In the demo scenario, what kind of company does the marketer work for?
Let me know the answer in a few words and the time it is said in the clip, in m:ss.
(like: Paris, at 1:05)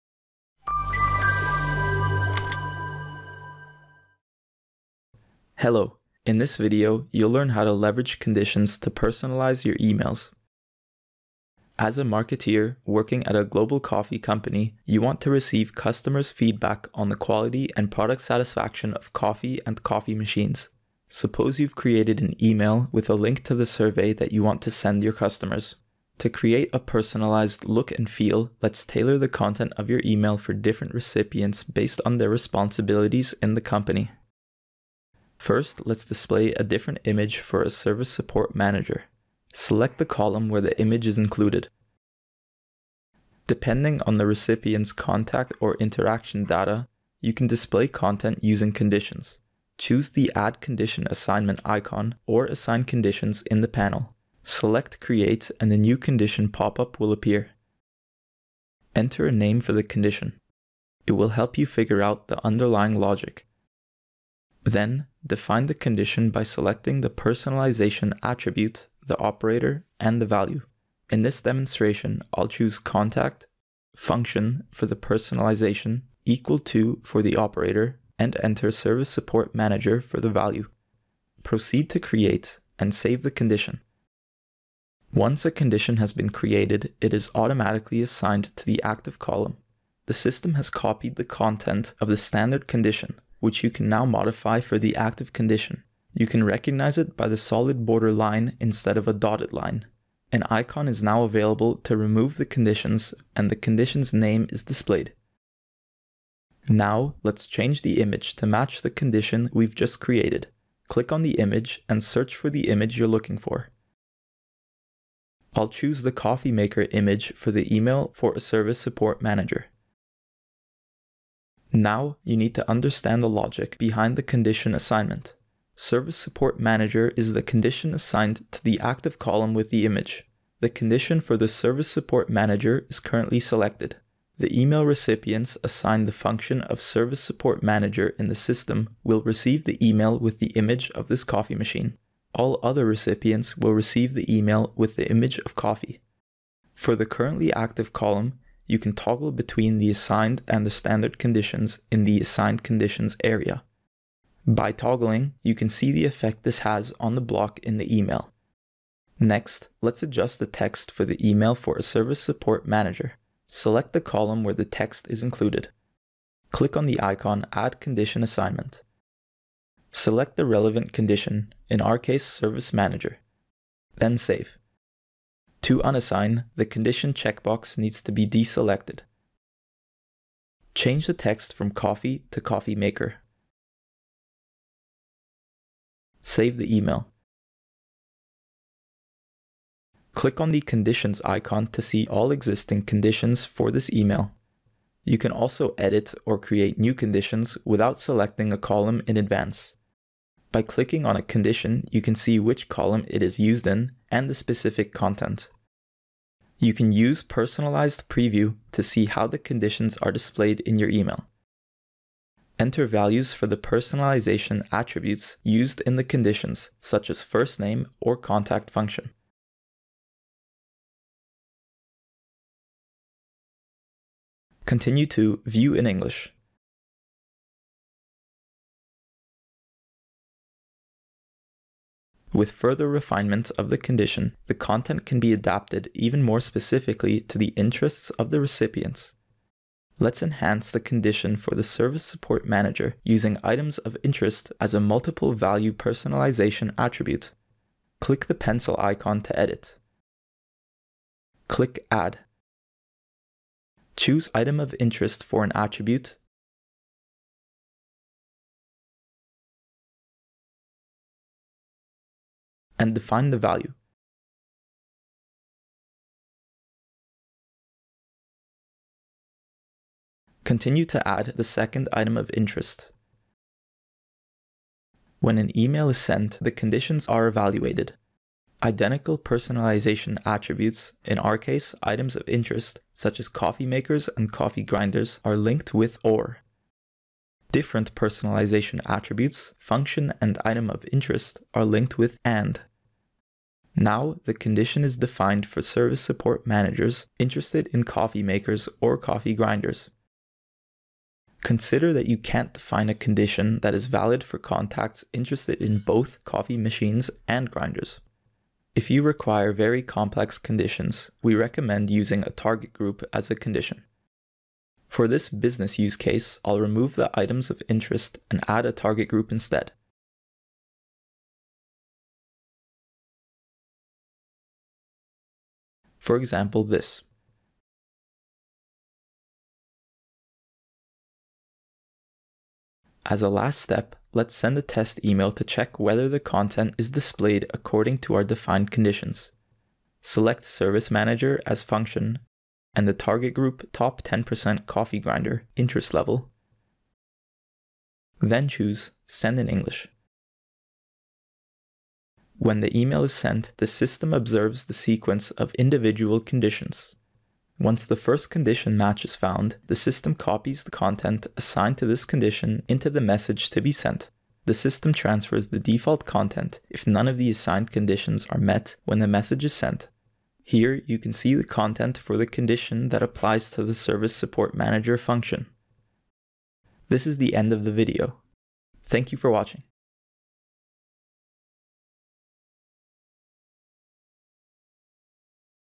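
Global coffee company, at 0:13.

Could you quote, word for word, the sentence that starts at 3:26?
You can use personalized preview to see how the conditions are displayed in your email.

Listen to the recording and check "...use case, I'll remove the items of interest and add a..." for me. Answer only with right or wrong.
right.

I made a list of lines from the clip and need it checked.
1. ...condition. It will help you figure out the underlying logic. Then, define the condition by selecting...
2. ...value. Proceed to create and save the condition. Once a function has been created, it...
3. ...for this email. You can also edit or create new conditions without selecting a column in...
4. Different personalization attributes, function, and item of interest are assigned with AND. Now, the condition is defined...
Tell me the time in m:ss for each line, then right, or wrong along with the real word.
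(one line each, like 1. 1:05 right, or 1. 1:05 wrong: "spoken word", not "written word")
1. 0:59 right
2. 1:20 wrong: "condition", not "function"
3. 3:13 right
4. 4:47 wrong: "linked", not "assigned".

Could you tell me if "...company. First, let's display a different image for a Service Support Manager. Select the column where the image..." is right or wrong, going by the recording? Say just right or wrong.
right.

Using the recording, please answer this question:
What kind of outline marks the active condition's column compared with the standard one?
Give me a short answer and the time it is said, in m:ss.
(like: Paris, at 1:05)
Solid border line, at 1:37.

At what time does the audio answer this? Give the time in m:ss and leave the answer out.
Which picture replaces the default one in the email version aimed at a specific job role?
1:56.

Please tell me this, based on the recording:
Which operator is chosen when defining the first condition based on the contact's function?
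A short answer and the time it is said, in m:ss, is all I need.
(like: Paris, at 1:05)
Equal to, at 1:16.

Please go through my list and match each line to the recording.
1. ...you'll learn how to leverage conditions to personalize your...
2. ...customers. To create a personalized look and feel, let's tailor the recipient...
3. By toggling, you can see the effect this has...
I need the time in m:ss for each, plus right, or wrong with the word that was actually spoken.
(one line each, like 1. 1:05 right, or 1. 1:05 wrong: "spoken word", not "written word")
1. 0:07 right
2. 0:25 wrong: "content", not "recipient"
3. 2:34 right.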